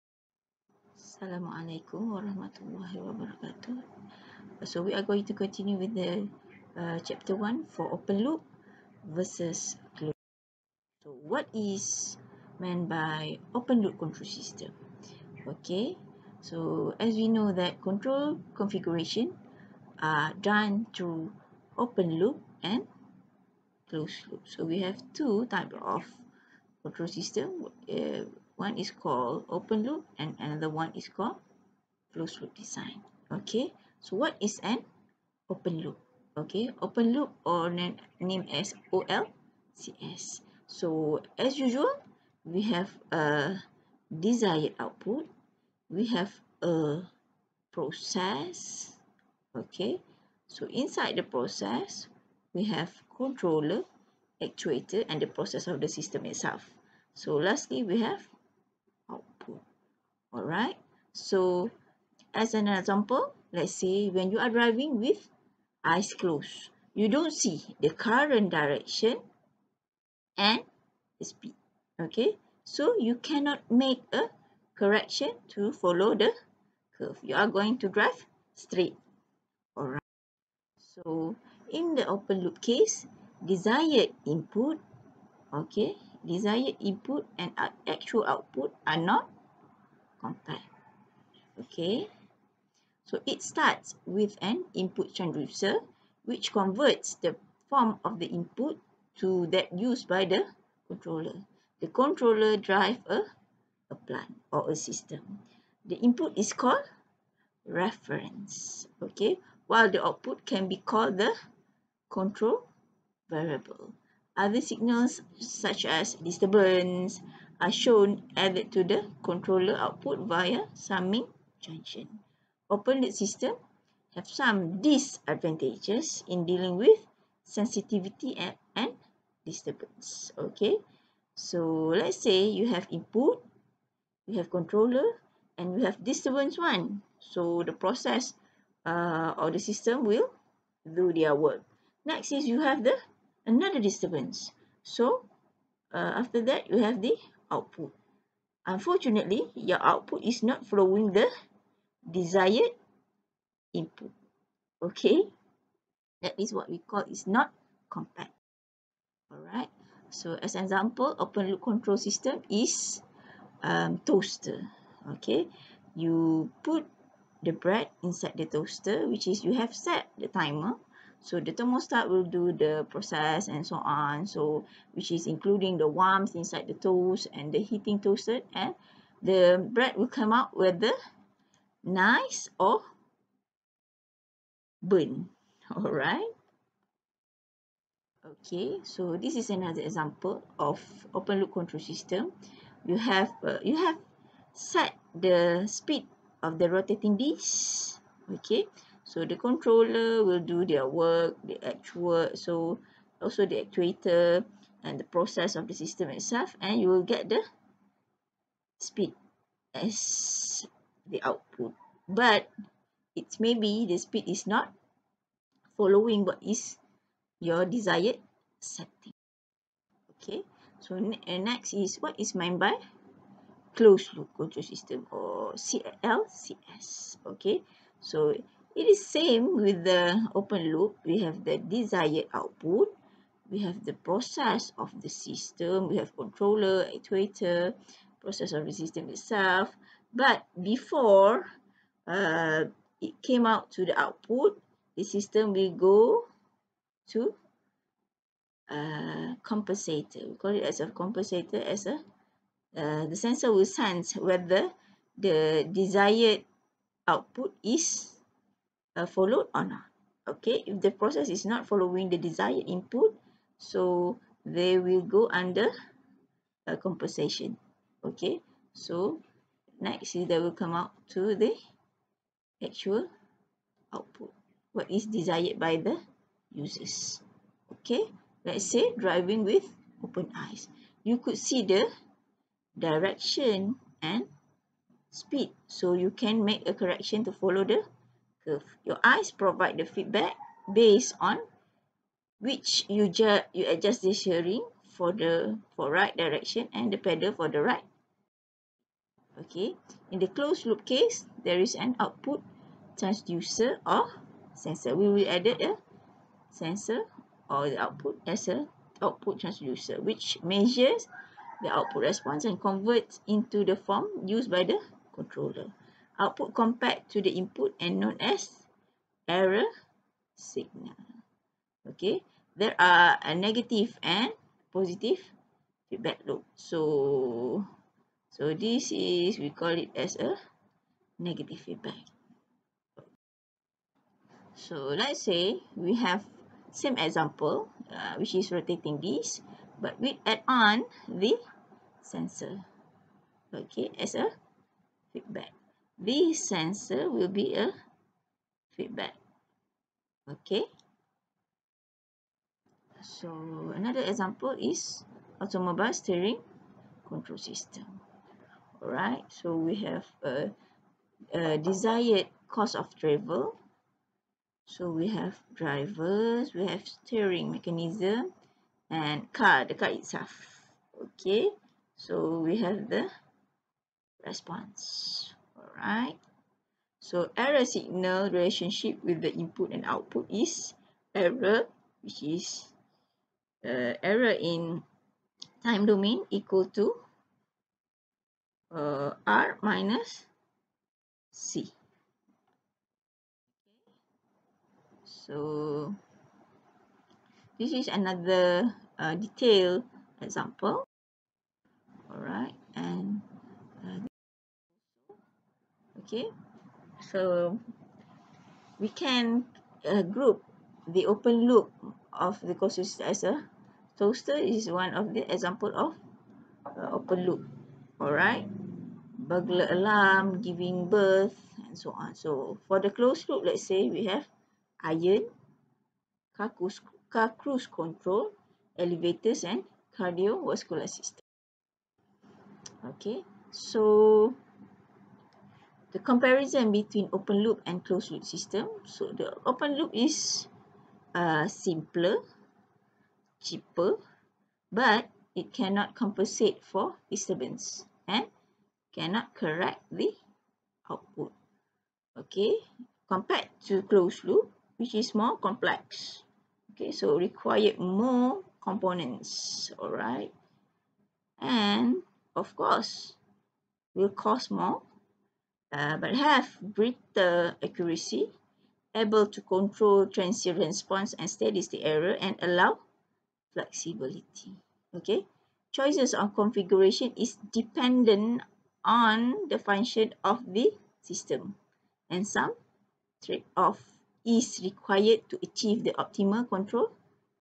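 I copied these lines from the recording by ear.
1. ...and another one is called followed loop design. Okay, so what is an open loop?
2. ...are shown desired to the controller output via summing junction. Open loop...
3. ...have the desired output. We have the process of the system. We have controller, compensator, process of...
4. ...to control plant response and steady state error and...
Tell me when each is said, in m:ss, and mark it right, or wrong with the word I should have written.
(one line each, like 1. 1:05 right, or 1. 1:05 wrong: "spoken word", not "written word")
1. 0:30 wrong: "closed", not "followed"
2. 1:57 wrong: "added", not "desired"
3. 3:51 wrong: "actuator", not "compensator"
4. 7:49 wrong: "transient", not "plant".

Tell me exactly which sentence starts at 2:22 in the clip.
Next is you have the another disturbance.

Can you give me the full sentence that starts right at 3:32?
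But it's maybe the speed is not following what is your desired setting.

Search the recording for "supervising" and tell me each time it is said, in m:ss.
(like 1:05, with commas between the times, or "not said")
not said.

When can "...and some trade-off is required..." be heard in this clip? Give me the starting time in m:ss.
8:02.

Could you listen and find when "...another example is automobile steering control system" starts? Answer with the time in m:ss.
5:53.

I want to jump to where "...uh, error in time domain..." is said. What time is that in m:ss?
6:23.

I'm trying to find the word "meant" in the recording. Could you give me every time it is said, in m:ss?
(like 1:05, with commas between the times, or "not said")
0:12, 3:42.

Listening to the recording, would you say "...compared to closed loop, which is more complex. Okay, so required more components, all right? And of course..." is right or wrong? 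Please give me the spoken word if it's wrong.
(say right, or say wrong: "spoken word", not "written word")
right.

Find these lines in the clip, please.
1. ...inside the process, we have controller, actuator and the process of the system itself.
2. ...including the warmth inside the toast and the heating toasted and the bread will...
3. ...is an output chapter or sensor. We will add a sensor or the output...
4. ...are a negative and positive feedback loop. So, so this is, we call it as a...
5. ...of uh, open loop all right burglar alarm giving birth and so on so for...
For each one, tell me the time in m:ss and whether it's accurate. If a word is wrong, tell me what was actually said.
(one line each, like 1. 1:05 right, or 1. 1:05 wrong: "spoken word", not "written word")
1. 0:50 right
2. 2:55 right
3. 5:01 wrong: "transducer", not "chapter"
4. 5:22 right
5. 6:55 right.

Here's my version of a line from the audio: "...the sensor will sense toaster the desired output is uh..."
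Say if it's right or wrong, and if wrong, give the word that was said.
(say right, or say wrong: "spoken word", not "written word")
wrong: "whether", not "toaster".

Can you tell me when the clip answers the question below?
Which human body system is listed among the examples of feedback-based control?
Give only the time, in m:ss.
7:09.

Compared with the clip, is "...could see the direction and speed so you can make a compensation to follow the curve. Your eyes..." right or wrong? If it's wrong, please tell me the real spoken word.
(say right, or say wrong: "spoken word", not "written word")
wrong: "correction", not "compensation".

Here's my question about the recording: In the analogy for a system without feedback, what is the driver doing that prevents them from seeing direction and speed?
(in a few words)
Driving with eyes closed.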